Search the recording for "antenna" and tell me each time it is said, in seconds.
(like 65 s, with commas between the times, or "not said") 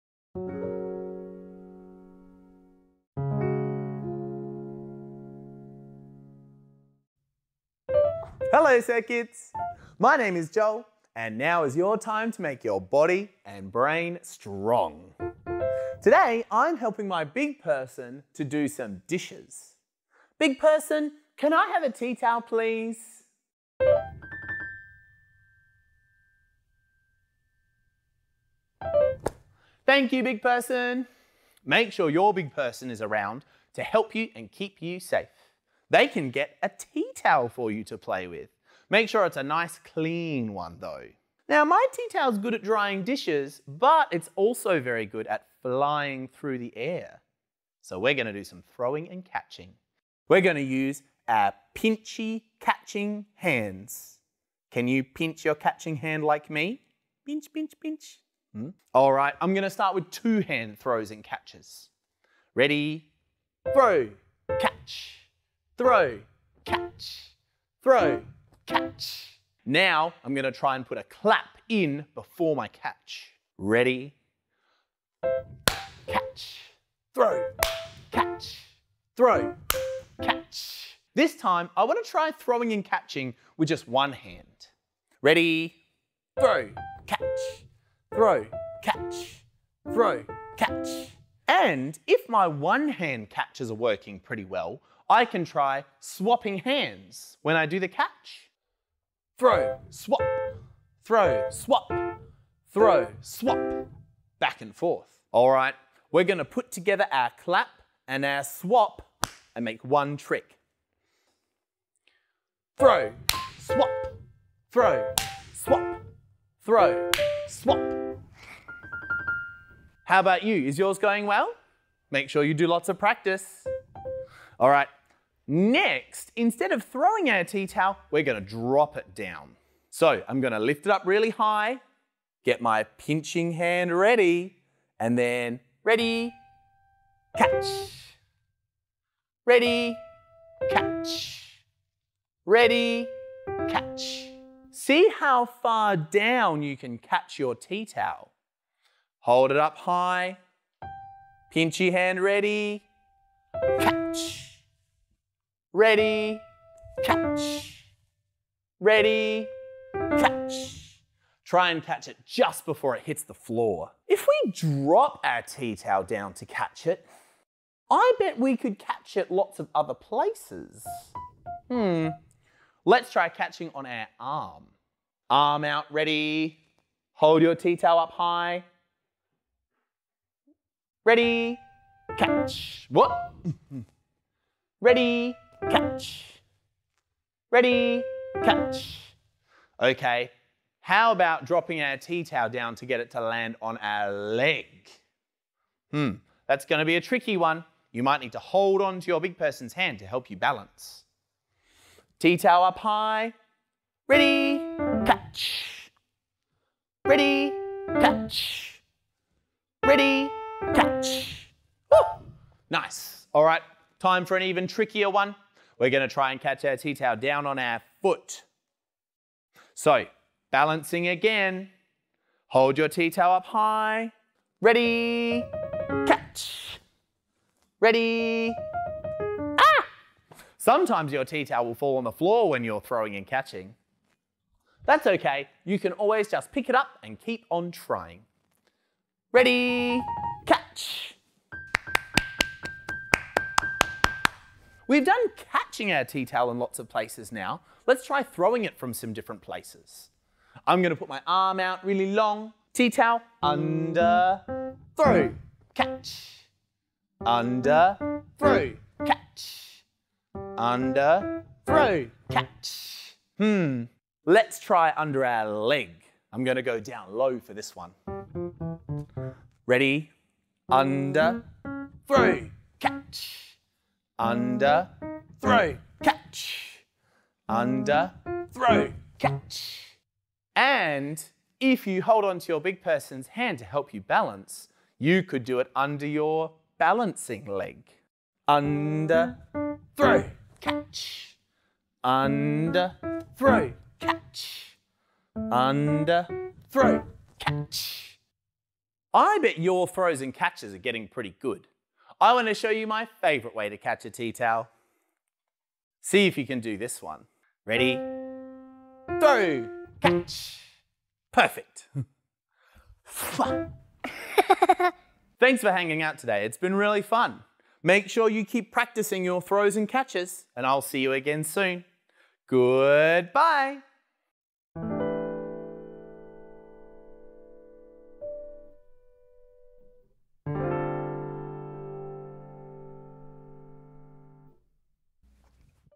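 not said.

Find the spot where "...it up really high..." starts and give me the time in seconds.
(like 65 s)
130 s.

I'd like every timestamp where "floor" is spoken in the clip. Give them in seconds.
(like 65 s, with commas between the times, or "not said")
163 s, 232 s.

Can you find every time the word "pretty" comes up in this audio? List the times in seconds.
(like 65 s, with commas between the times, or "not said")
94 s, 301 s.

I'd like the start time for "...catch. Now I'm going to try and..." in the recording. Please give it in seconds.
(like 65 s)
68 s.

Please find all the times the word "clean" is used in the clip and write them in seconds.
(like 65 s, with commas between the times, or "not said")
39 s.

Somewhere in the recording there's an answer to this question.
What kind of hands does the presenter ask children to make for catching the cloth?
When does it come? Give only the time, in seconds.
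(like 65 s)
51 s.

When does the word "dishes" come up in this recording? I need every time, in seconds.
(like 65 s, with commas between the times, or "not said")
19 s, 43 s.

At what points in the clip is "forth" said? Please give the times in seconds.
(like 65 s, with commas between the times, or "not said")
104 s.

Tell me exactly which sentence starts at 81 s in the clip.
This time I want to try throwing and catching with just one hand.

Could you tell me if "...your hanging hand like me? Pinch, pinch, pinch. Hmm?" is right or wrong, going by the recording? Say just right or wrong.
wrong.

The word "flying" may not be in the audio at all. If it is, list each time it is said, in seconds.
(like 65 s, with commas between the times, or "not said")
45 s.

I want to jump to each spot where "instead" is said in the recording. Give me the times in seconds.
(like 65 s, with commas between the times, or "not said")
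126 s.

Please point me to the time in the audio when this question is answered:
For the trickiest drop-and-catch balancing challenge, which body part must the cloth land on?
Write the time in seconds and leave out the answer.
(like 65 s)
218 s.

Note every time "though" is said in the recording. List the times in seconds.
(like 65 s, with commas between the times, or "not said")
40 s.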